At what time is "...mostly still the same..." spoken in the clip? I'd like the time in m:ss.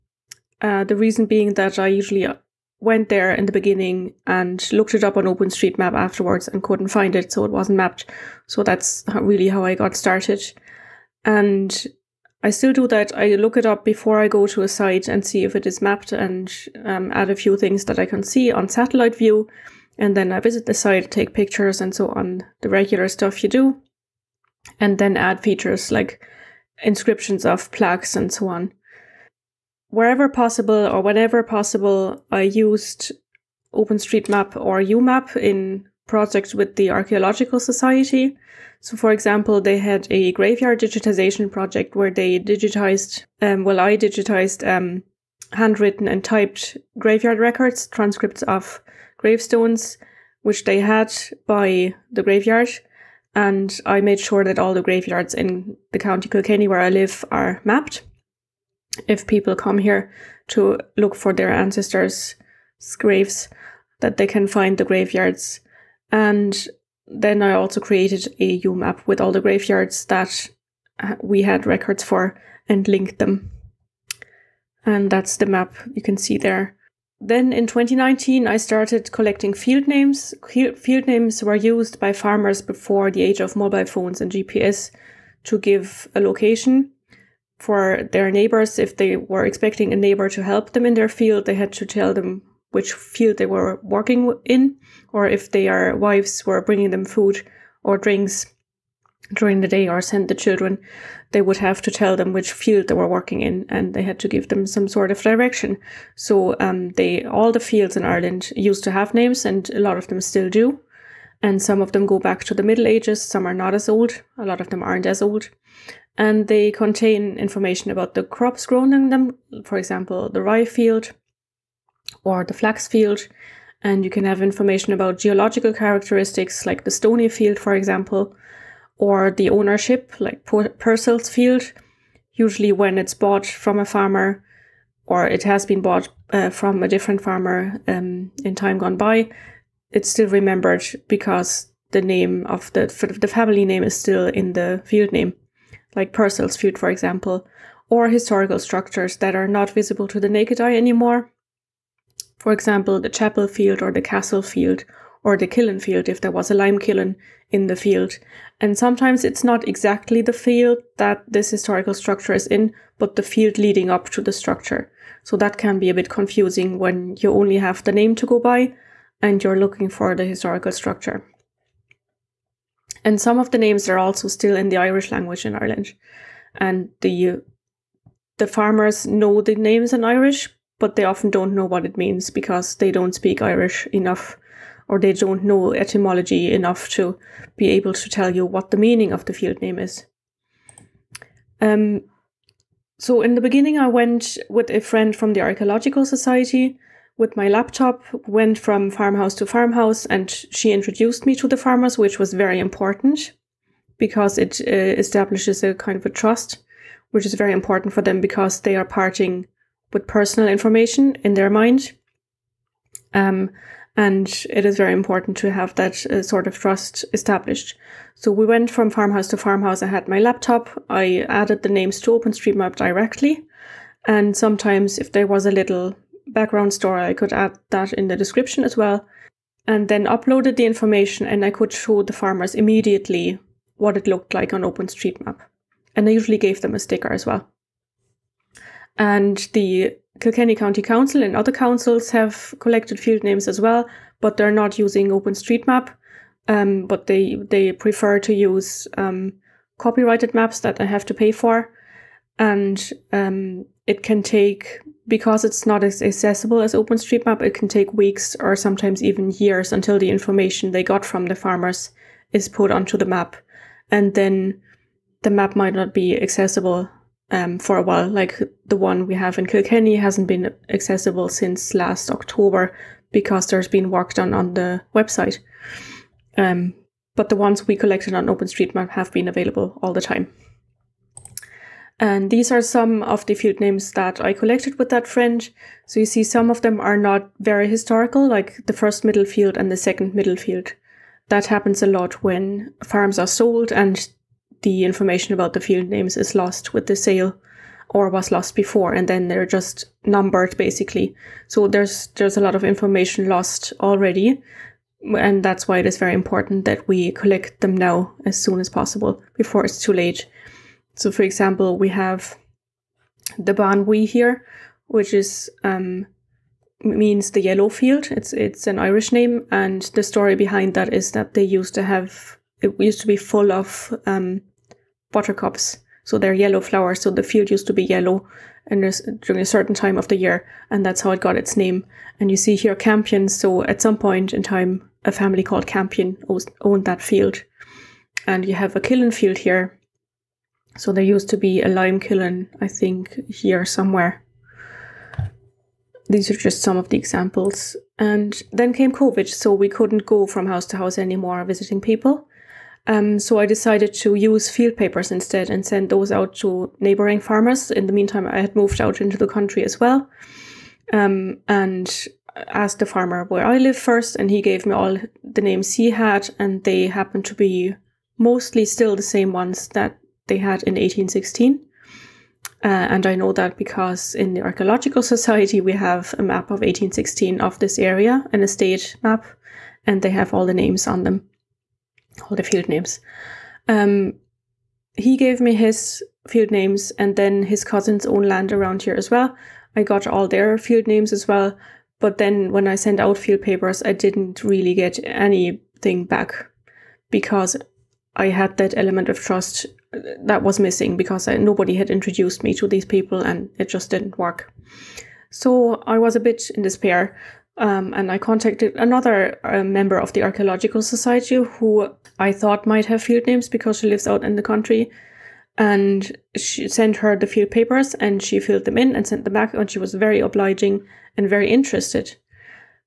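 6:08.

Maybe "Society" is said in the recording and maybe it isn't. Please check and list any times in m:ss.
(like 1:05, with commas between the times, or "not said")
0:37, 3:16, 6:15, 6:50.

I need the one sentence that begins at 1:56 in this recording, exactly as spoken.
And they contain information about the crops grown in them, for example, the rye field or the flax field.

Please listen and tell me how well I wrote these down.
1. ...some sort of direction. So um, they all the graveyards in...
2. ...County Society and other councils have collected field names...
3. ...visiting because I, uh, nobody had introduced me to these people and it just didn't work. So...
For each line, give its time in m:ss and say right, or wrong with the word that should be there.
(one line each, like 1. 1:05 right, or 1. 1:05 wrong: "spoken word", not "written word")
1. 1:44 wrong: "fields", not "graveyards"
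2. 4:00 wrong: "Council", not "Society"
3. 6:40 wrong: "missing", not "visiting".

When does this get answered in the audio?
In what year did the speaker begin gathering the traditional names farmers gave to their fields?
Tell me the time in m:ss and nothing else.
1:17.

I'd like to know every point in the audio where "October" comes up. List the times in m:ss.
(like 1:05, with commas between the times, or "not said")
4:32.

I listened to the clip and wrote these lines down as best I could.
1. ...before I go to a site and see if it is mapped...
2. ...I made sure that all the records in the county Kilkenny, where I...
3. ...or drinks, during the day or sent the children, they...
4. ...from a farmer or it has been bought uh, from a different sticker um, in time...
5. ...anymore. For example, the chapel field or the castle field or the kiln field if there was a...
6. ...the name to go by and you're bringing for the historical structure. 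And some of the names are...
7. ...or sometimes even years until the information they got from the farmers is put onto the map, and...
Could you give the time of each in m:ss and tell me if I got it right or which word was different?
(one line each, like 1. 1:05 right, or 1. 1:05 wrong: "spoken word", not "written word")
1. 0:13 right
2. 0:53 wrong: "graveyards", not "records"
3. 1:37 right
4. 2:13 wrong: "farmer", not "sticker"
5. 2:30 right
6. 2:47 wrong: "looking", not "bringing"
7. 4:18 right.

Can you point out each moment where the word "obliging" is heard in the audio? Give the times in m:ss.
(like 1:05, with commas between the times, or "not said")
7:00.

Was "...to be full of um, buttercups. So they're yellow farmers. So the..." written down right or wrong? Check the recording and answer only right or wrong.
wrong.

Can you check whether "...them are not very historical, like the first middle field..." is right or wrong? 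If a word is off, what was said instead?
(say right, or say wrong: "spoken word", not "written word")
right.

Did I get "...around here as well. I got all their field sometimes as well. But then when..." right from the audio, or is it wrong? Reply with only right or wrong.
wrong.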